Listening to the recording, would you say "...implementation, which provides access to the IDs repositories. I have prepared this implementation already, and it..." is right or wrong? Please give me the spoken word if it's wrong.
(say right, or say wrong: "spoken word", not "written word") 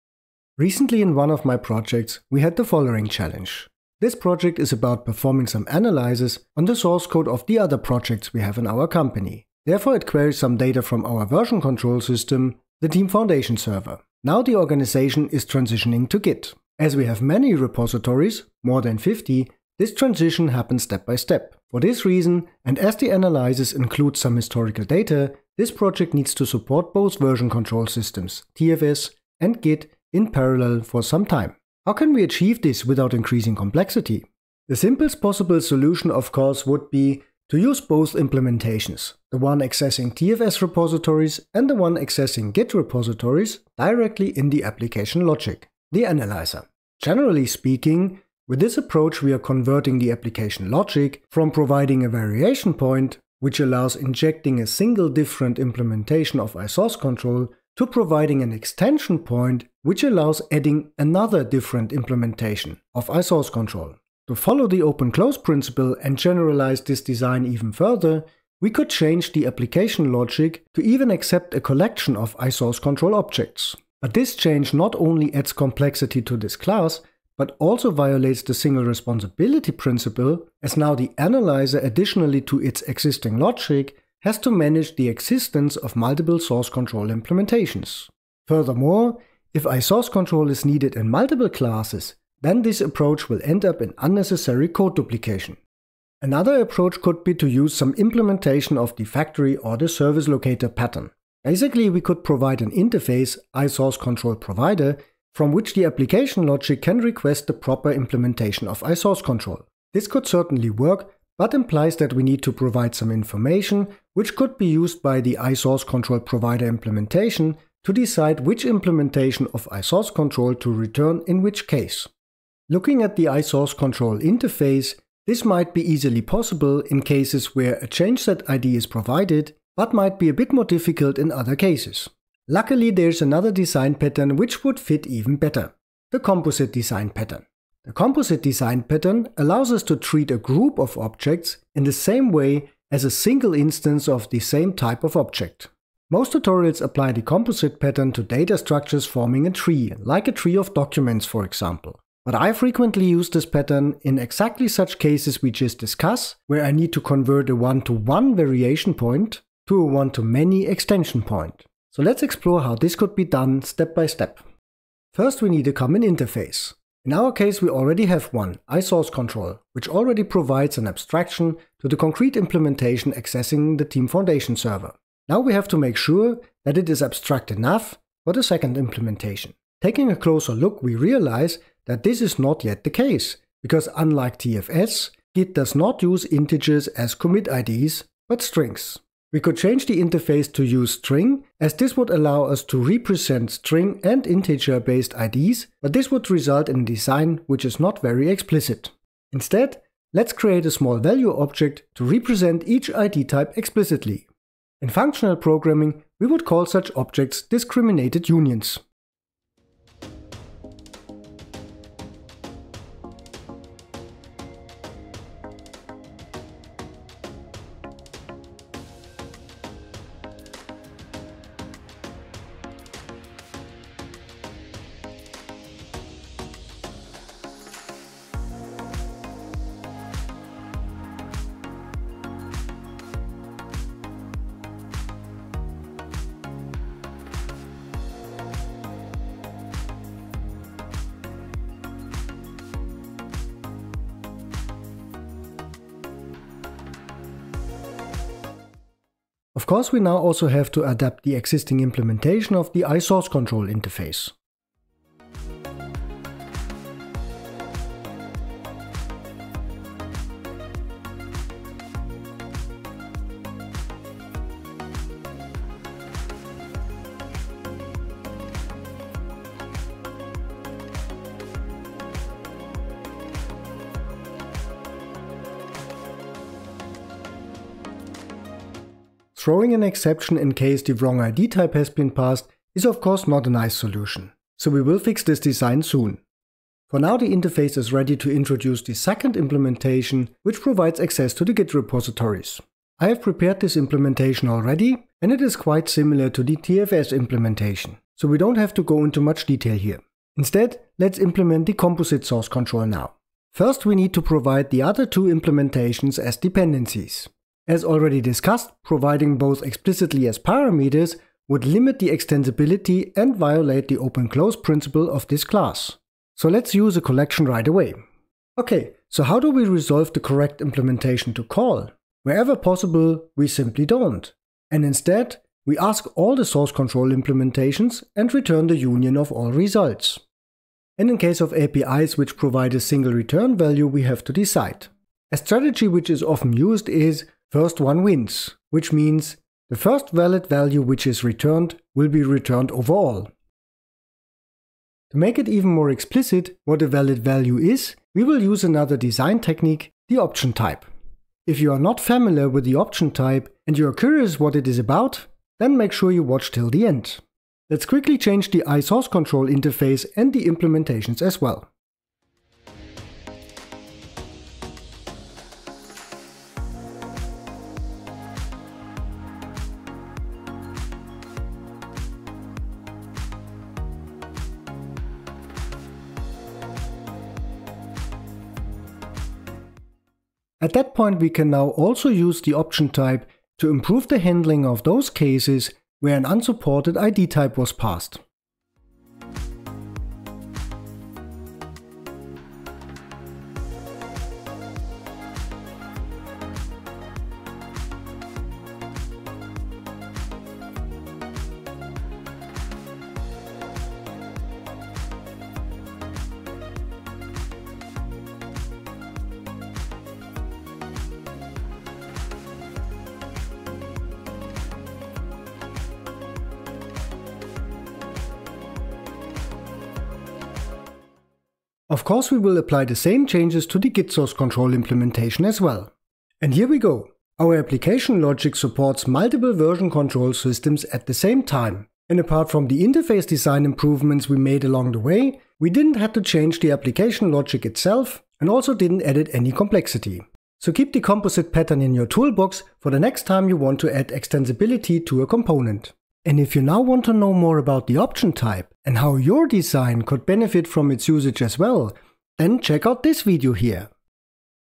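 wrong: "Git", not "IDs".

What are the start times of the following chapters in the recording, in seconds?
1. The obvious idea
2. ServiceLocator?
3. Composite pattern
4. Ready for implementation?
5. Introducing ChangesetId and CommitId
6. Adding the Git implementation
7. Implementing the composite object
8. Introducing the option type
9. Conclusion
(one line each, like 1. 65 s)
1. 34 s
2. 96 s
3. 132 s
4. 165 s
5. 200 s
6. 286 s
7. 303 s
8. 345 s
9. 426 s.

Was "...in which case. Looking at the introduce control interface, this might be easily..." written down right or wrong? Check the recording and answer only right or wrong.
wrong.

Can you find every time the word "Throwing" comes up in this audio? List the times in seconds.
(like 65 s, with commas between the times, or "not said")
279 s.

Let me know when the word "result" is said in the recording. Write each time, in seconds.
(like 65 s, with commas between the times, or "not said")
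196 s, 329 s.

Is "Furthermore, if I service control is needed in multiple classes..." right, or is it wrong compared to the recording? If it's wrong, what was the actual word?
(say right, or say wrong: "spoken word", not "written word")
wrong: "source", not "service".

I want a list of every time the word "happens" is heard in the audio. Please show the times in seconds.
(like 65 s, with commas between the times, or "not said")
20 s.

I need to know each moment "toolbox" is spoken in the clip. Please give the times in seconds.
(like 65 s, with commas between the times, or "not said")
442 s.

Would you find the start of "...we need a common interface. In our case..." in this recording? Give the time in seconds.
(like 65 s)
165 s.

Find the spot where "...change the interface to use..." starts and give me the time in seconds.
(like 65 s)
189 s.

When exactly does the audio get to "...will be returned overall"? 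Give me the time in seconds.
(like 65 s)
341 s.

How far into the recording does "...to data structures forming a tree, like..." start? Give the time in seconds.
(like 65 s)
148 s.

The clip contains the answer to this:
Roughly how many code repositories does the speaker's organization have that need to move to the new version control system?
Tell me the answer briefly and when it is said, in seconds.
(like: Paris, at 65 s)
more than 50, at 18 s.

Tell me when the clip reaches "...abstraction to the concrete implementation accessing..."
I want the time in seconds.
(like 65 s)
170 s.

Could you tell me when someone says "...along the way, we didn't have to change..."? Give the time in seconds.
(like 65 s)
434 s.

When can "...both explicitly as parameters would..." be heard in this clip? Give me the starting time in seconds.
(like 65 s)
309 s.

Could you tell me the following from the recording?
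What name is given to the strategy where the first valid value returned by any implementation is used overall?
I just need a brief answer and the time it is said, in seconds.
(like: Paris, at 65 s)
First one wins, at 337 s.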